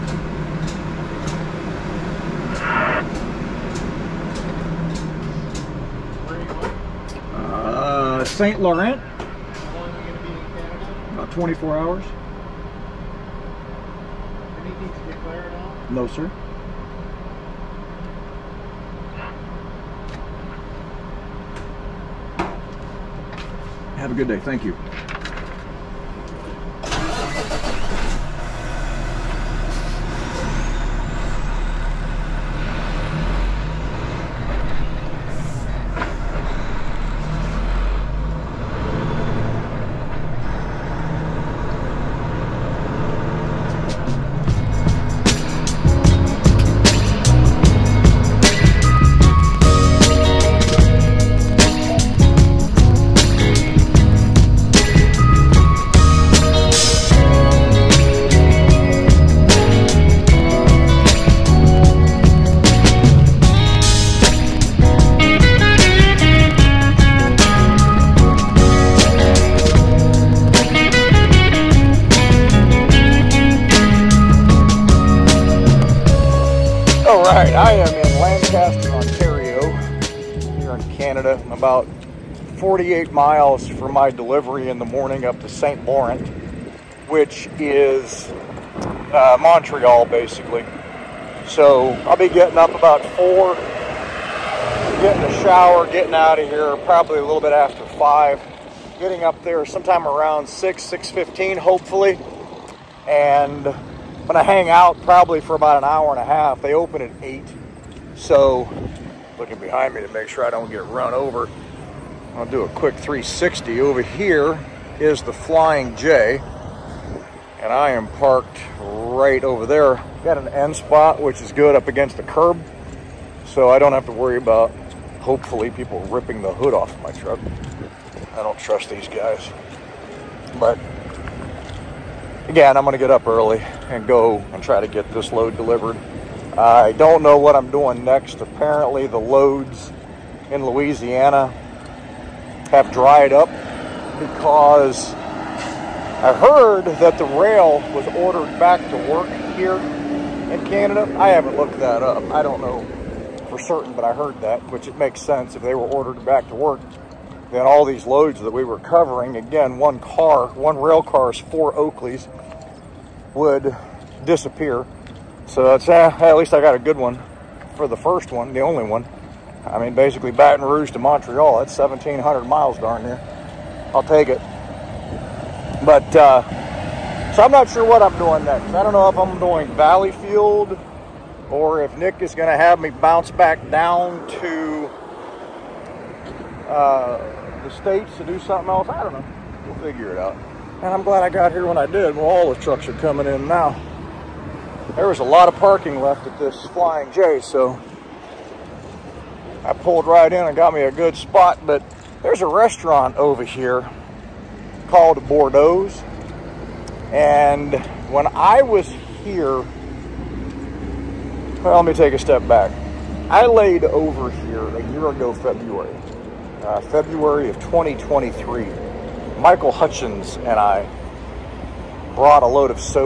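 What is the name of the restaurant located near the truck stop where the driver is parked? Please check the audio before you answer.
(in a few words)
Bordeaux's.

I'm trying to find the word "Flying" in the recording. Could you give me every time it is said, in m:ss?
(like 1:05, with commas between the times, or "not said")
1:55, 3:16.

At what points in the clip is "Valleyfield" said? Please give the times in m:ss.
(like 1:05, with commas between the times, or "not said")
2:59.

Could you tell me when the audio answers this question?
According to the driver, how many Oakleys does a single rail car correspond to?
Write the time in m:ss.
2:41.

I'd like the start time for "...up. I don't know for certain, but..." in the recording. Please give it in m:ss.
2:32.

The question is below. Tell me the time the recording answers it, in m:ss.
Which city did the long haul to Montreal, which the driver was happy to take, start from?
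2:50.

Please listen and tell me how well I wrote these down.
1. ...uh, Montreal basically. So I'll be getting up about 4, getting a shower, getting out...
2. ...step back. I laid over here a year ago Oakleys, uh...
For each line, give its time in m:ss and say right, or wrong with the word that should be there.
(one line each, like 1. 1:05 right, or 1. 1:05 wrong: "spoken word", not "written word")
1. 1:29 right
2. 3:32 wrong: "February", not "Oakleys".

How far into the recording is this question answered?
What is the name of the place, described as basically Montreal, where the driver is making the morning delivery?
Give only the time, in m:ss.
1:25.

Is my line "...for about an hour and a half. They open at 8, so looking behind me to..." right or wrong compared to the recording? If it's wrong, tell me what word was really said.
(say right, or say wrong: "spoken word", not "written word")
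right.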